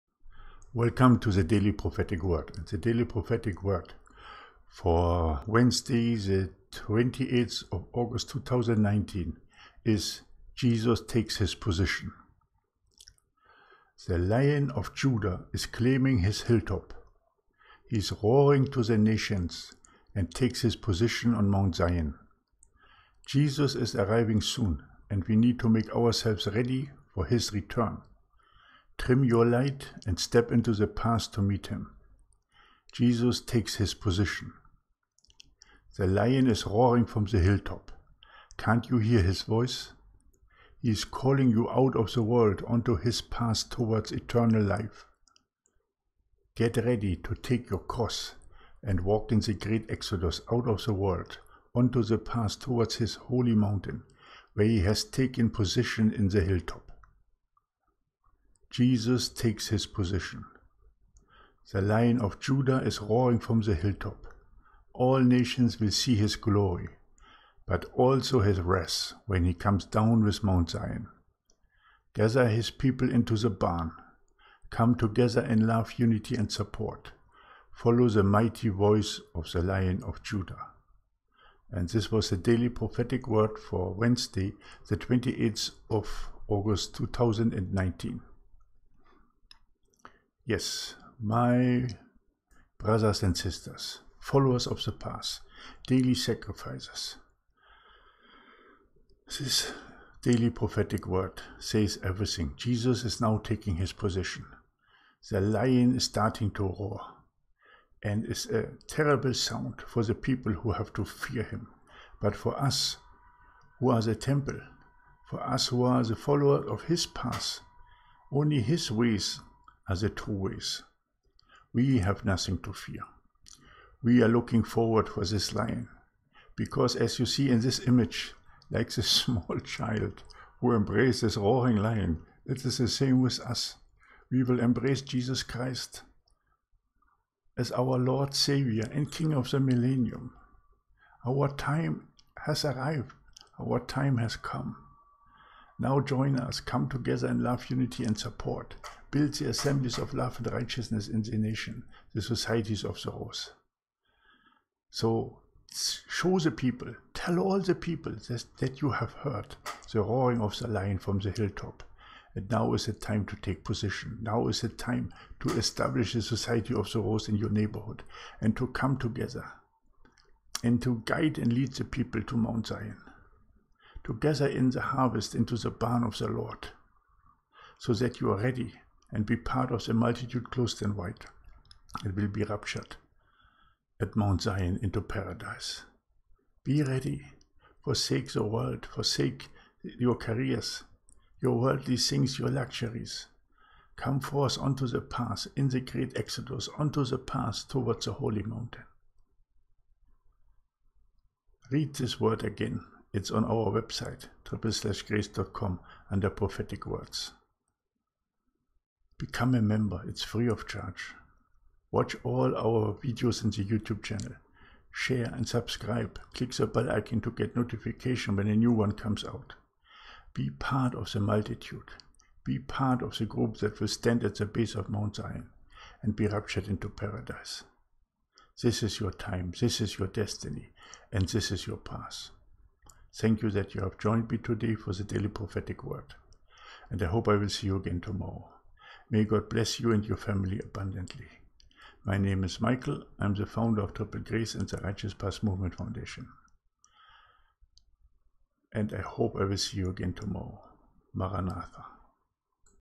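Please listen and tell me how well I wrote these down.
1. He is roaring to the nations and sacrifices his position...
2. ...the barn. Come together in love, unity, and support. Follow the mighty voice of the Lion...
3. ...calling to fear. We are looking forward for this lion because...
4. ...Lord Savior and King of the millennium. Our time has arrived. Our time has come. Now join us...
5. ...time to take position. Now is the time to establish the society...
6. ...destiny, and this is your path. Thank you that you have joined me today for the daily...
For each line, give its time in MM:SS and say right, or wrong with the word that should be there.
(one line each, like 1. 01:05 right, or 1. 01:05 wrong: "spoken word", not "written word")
1. 00:17 wrong: "takes", not "sacrifices"
2. 01:13 right
3. 02:02 wrong: "nothing", not "calling"
4. 02:17 right
5. 02:42 right
6. 03:50 right.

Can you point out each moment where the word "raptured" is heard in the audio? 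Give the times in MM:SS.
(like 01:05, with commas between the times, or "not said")
03:02, 03:46.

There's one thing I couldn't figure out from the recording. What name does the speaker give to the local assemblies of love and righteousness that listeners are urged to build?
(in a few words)
Societies of the rose.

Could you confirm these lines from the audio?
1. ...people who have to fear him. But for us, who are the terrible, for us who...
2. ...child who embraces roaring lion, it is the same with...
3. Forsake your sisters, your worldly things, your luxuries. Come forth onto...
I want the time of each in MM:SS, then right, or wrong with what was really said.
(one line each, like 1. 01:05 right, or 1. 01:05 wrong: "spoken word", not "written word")
1. 01:50 wrong: "temple", not "terrible"
2. 02:09 right
3. 03:08 wrong: "careers", not "sisters".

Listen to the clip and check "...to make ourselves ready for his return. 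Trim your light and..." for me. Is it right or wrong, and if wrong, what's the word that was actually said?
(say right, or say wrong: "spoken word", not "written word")
right.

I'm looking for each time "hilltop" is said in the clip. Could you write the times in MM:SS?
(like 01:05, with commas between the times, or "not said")
00:16, 00:37, 00:56, 01:03, 02:41.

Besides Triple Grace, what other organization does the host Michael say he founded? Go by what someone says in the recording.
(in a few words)
Righteous Path Movement Foundation.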